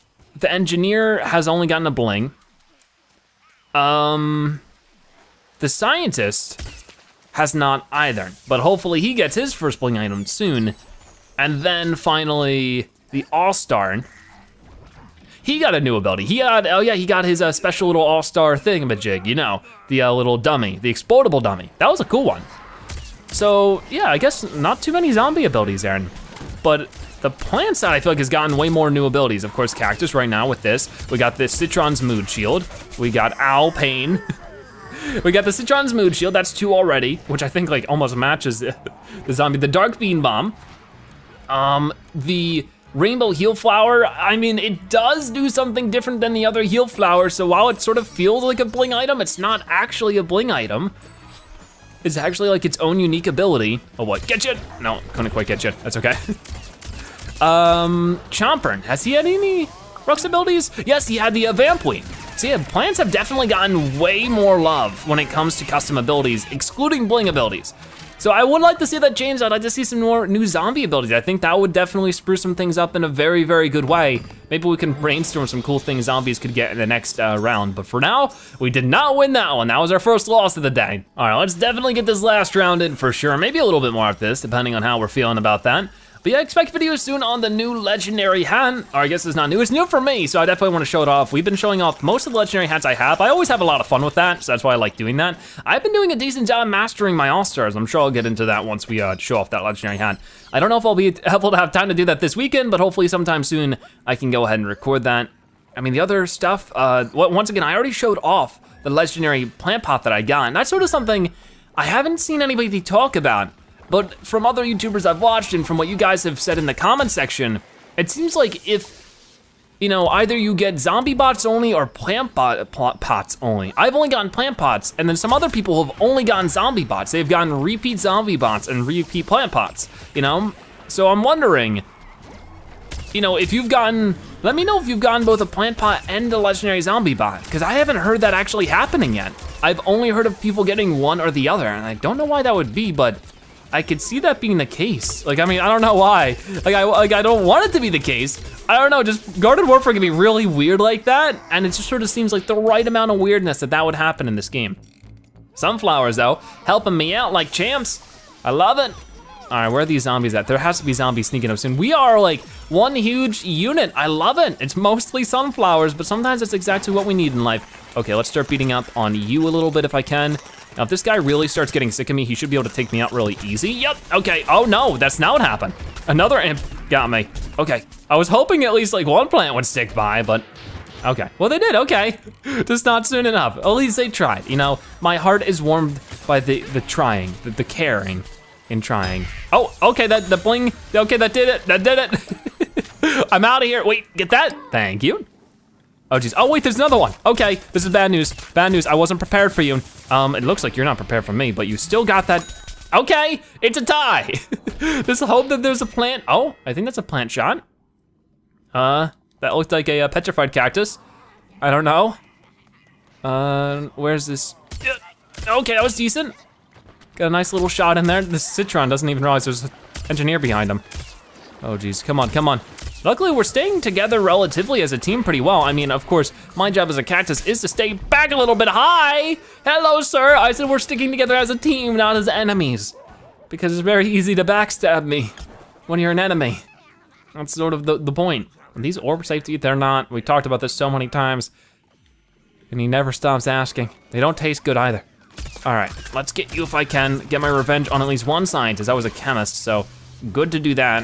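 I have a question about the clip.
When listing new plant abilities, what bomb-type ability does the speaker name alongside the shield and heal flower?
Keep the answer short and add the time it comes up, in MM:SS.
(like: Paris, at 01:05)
Dark Bean Bomb, at 00:39.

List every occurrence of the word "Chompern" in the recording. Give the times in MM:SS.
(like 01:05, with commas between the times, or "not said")
00:58.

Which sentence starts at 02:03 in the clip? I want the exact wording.
I've only gotten plant pots, and then some other people have only gotten zombie bots.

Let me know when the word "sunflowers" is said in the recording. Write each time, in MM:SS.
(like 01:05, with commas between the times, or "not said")
02:35, 02:45.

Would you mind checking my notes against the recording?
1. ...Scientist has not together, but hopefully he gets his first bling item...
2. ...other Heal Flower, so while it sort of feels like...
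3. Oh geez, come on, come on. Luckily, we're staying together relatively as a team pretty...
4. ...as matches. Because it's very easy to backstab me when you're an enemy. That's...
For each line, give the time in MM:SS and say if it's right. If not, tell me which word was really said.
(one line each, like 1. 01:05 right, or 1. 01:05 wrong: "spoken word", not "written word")
1. 00:05 wrong: "either", not "together"
2. 00:46 right
3. 03:41 right
4. 03:52 wrong: "enemies", not "matches".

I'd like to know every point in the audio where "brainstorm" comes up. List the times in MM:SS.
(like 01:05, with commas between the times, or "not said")
01:14.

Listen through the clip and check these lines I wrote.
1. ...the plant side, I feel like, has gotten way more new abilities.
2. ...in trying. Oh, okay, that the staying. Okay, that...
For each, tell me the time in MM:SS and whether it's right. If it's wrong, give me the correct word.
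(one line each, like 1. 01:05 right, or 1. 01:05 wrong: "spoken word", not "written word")
1. 00:27 right
2. 03:08 wrong: "bling", not "staying".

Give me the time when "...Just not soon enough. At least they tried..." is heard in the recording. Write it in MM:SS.
03:02.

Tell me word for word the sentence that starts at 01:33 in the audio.
I always have a lot of fun with that, so that's why I like doing that.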